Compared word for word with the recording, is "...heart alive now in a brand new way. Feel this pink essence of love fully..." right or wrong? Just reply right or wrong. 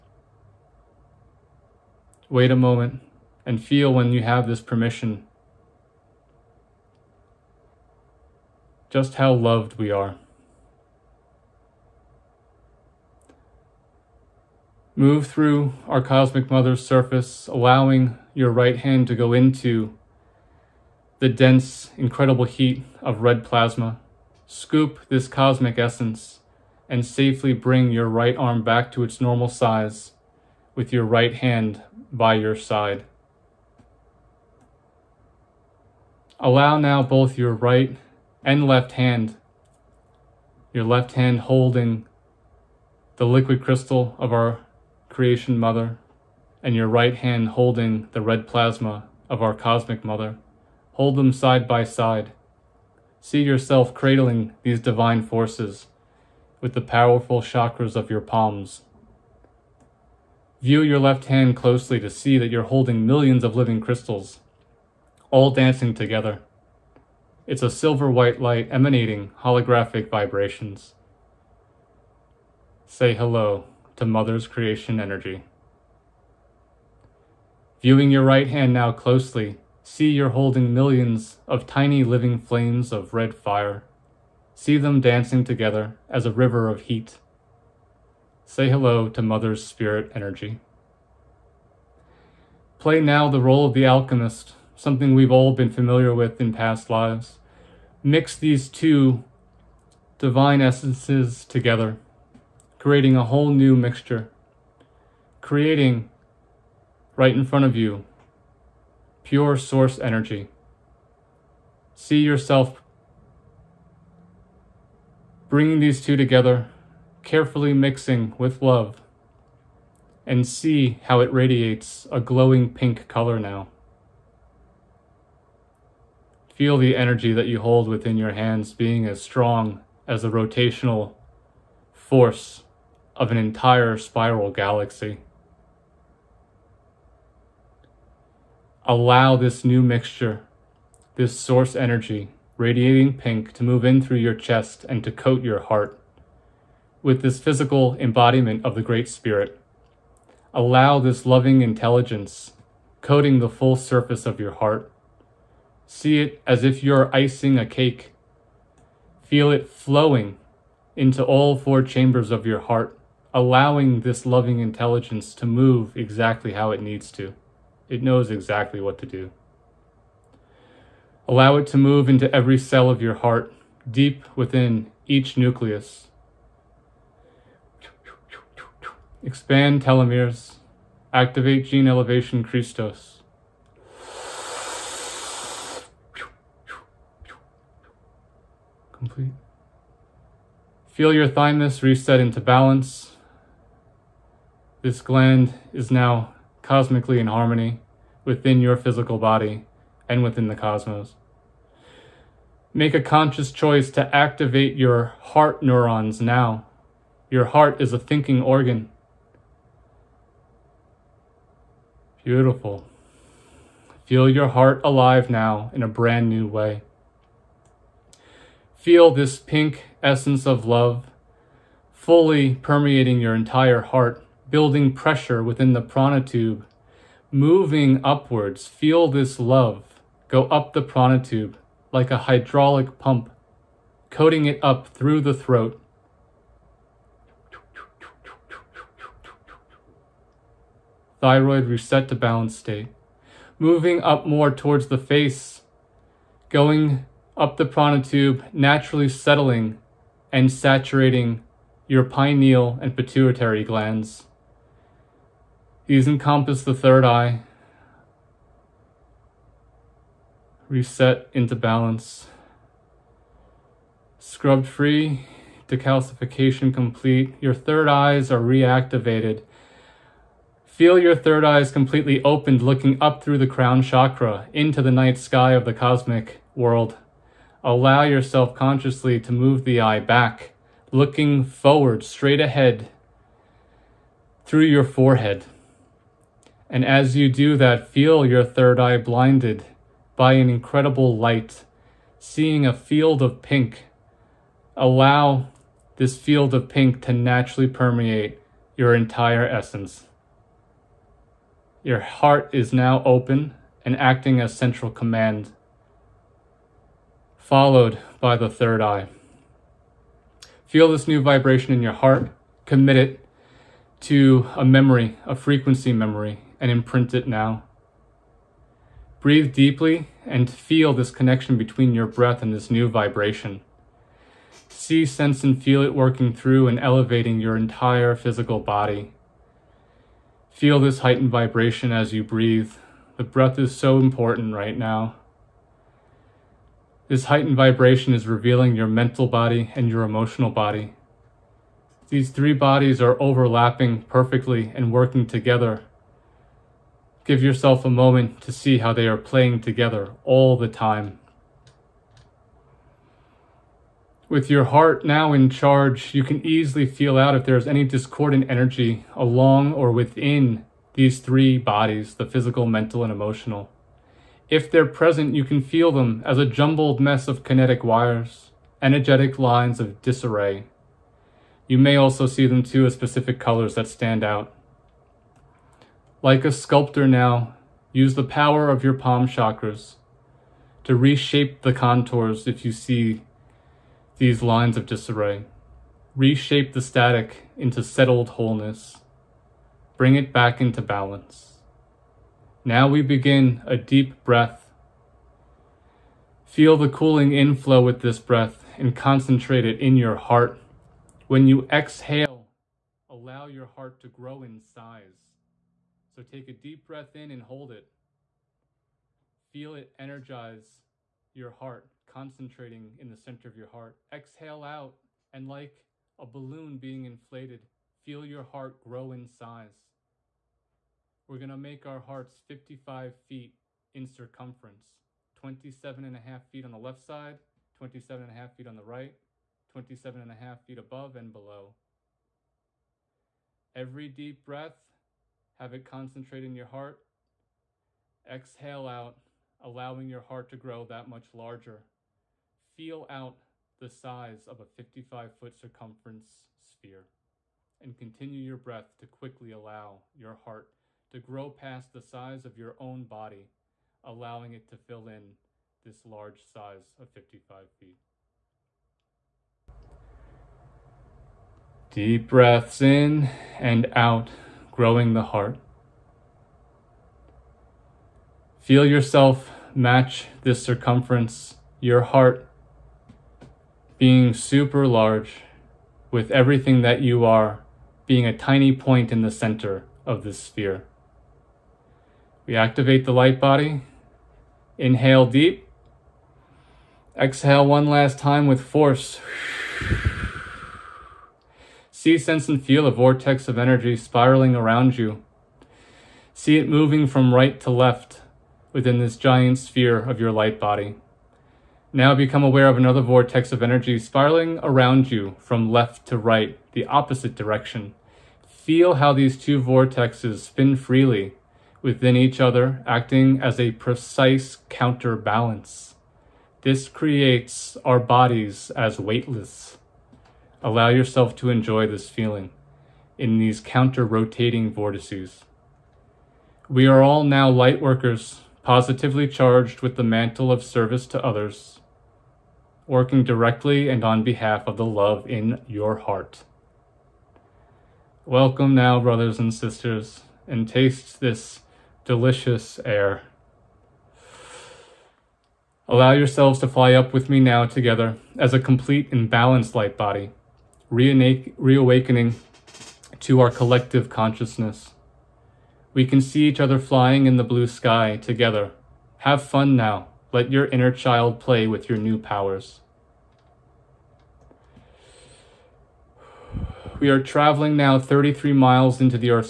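right.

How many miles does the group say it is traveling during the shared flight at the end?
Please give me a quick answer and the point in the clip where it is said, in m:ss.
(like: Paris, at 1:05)
33, at 9:27.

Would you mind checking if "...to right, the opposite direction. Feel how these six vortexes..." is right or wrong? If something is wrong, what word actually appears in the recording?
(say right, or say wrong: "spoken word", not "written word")
wrong: "two", not "six".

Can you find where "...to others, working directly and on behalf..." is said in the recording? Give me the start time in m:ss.
8:51.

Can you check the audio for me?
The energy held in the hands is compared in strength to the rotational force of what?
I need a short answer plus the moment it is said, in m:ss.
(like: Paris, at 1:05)
An entire spiral galaxy, at 2:13.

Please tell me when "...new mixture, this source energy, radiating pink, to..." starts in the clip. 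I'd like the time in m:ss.
2:19.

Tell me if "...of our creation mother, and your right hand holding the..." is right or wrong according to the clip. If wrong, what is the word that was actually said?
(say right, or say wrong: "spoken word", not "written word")
right.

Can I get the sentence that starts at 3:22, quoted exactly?
Make a conscious choice to activate your heart neurons now.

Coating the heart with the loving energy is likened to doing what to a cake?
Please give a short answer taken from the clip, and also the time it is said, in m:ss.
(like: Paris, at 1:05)
Icing, at 2:37.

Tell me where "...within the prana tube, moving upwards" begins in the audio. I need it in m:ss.
3:45.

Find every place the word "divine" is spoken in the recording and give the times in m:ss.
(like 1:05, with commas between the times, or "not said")
0:54, 1:40.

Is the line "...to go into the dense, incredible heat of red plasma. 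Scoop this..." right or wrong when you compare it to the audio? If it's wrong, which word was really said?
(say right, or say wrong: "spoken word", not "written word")
right.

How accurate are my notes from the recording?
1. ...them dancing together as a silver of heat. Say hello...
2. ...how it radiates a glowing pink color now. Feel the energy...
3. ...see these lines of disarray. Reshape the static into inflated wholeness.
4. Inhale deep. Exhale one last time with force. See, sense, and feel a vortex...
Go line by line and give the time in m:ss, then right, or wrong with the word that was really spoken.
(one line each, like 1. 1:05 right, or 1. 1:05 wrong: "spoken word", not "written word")
1. 1:24 wrong: "river", not "silver"
2. 2:01 right
3. 6:22 wrong: "settled", not "inflated"
4. 8:04 right.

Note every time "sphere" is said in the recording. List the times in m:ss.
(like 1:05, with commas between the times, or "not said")
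7:26, 8:00, 8:19.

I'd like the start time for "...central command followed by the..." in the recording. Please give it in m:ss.
5:04.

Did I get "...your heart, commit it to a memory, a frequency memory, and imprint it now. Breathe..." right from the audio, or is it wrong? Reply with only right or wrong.
right.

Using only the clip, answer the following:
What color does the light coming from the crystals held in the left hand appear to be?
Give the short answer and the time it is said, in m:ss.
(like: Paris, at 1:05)
Silver white, at 1:07.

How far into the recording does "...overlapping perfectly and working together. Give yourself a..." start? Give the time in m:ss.
5:43.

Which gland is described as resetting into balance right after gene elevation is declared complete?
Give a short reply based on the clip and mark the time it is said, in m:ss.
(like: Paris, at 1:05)
Thymus, at 3:11.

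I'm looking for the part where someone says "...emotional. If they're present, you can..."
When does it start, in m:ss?
6:03.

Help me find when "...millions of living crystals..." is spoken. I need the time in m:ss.
1:03.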